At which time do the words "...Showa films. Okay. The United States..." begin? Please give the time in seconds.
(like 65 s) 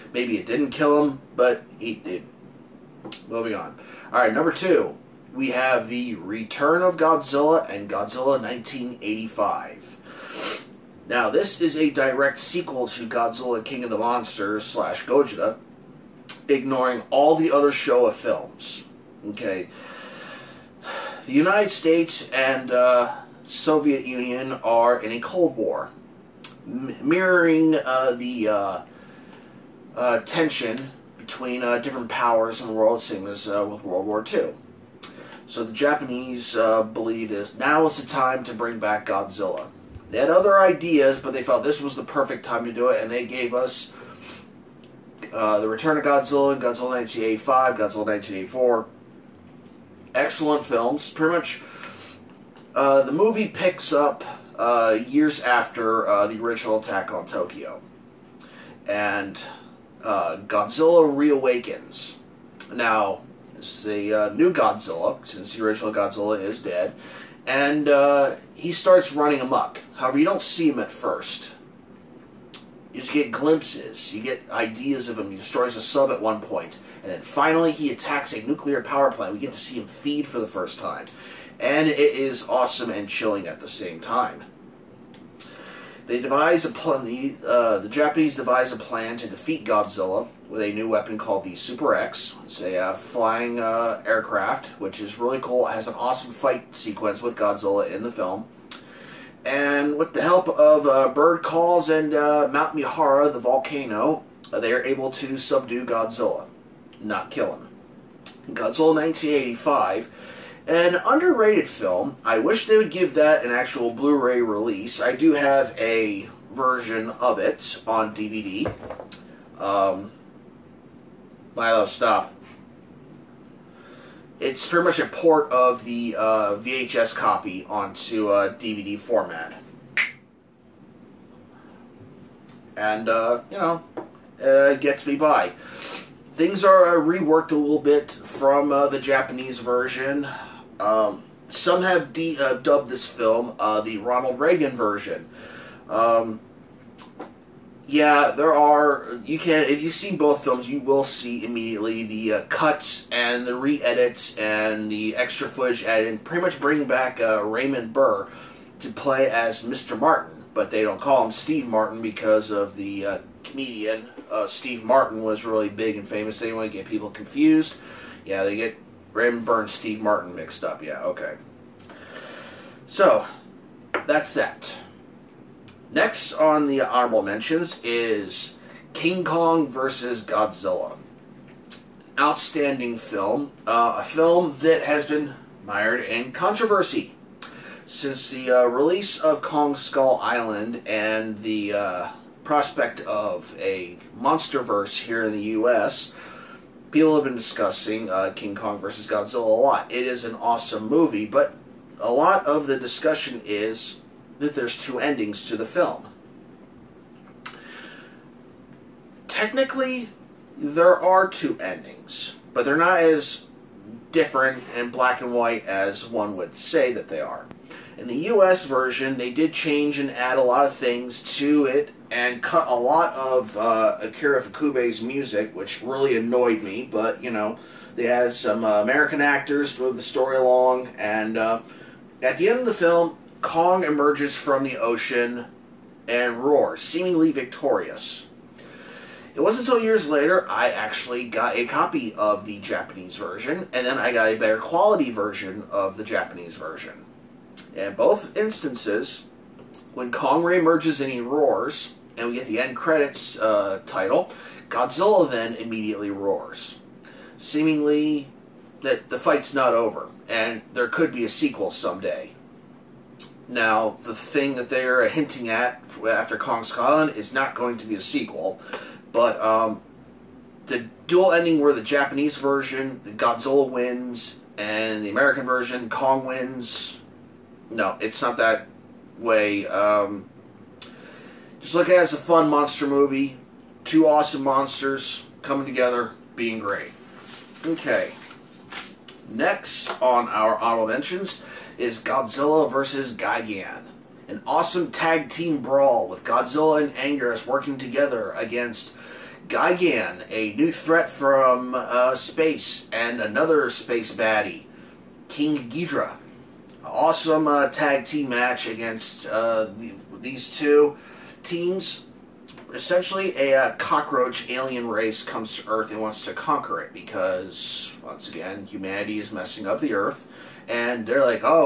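17 s.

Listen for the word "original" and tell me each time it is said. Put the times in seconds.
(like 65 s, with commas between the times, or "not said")
56 s, 65 s.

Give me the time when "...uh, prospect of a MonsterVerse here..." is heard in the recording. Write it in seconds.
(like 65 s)
191 s.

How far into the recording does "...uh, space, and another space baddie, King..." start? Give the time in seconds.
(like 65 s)
301 s.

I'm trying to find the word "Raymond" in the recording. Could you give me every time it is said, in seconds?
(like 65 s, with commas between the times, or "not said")
157 s, 169 s.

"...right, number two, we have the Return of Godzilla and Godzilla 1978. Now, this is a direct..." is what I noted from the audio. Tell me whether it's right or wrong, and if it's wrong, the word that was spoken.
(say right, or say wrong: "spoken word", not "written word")
wrong: "1985", not "1978".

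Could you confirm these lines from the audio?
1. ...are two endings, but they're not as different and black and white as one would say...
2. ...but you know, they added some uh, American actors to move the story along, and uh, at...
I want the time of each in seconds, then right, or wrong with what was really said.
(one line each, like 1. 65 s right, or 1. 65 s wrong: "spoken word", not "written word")
1. 211 s right
2. 226 s right.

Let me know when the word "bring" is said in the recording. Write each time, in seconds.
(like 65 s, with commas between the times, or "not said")
38 s, 156 s.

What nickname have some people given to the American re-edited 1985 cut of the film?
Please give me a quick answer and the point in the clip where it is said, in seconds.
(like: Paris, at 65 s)
the Ronald Reagan version, at 144 s.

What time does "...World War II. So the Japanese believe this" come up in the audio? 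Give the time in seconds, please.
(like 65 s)
33 s.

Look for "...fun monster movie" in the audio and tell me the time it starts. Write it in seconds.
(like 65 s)
282 s.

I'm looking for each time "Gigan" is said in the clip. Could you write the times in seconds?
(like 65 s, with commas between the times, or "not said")
293 s, 299 s.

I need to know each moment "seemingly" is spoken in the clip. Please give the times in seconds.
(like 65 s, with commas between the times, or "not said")
236 s, 257 s.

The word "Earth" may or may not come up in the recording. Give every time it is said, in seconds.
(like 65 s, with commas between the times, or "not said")
315 s, 319 s.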